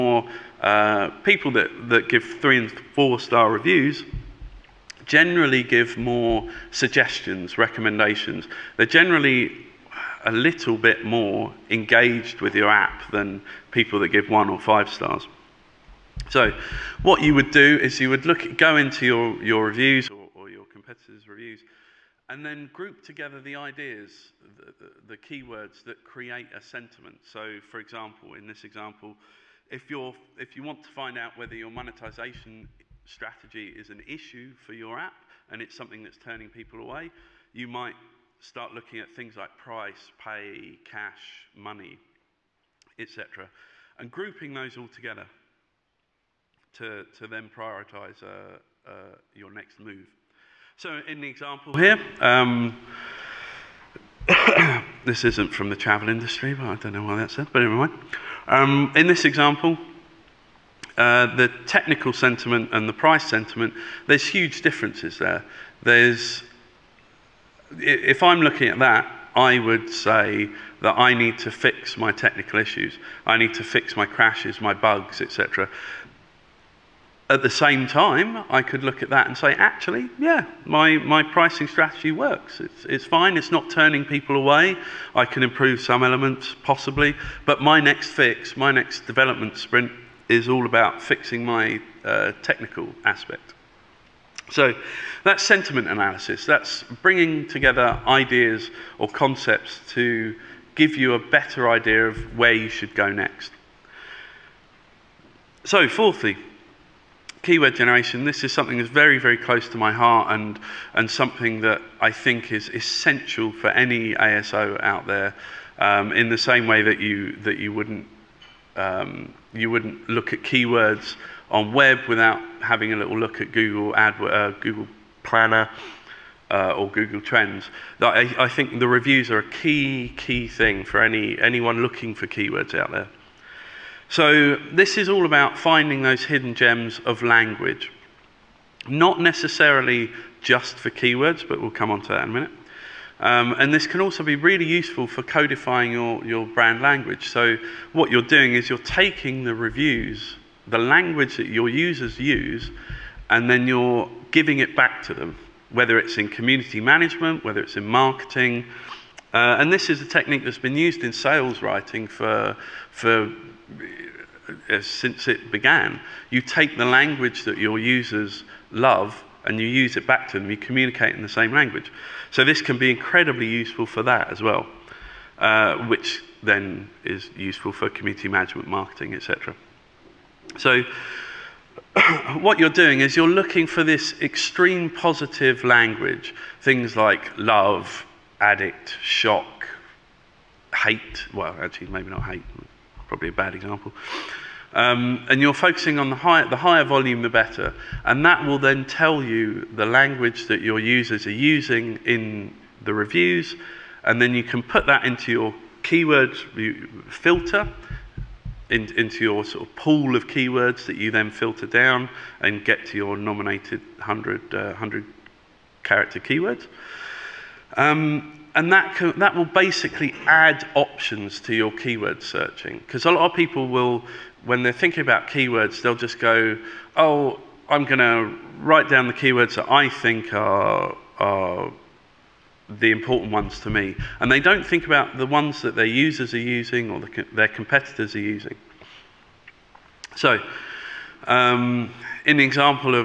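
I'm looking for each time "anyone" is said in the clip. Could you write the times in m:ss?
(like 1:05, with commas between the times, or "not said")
2:11.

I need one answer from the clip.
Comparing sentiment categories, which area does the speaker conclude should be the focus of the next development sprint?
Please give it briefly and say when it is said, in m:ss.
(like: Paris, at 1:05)
Technical aspect, at 1:32.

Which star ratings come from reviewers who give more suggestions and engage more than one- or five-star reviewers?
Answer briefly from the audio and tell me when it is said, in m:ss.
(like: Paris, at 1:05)
3 and 4 stars, at 0:02.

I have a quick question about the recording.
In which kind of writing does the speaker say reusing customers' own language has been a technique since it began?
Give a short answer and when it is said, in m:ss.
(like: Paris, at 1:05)
Sales writing, at 2:41.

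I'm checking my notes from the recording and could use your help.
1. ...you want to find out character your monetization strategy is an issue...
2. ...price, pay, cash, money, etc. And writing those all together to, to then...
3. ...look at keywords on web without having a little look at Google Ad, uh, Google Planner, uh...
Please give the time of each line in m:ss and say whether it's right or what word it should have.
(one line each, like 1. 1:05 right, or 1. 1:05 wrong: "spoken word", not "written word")
1. 0:30 wrong: "whether", not "character"
2. 0:39 wrong: "grouping", not "writing"
3. 2:00 right.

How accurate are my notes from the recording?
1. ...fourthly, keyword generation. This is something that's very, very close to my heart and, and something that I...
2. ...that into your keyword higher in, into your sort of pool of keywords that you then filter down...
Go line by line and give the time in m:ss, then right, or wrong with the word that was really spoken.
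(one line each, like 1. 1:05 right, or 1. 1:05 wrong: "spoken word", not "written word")
1. 1:45 right
2. 3:24 wrong: "filter", not "higher".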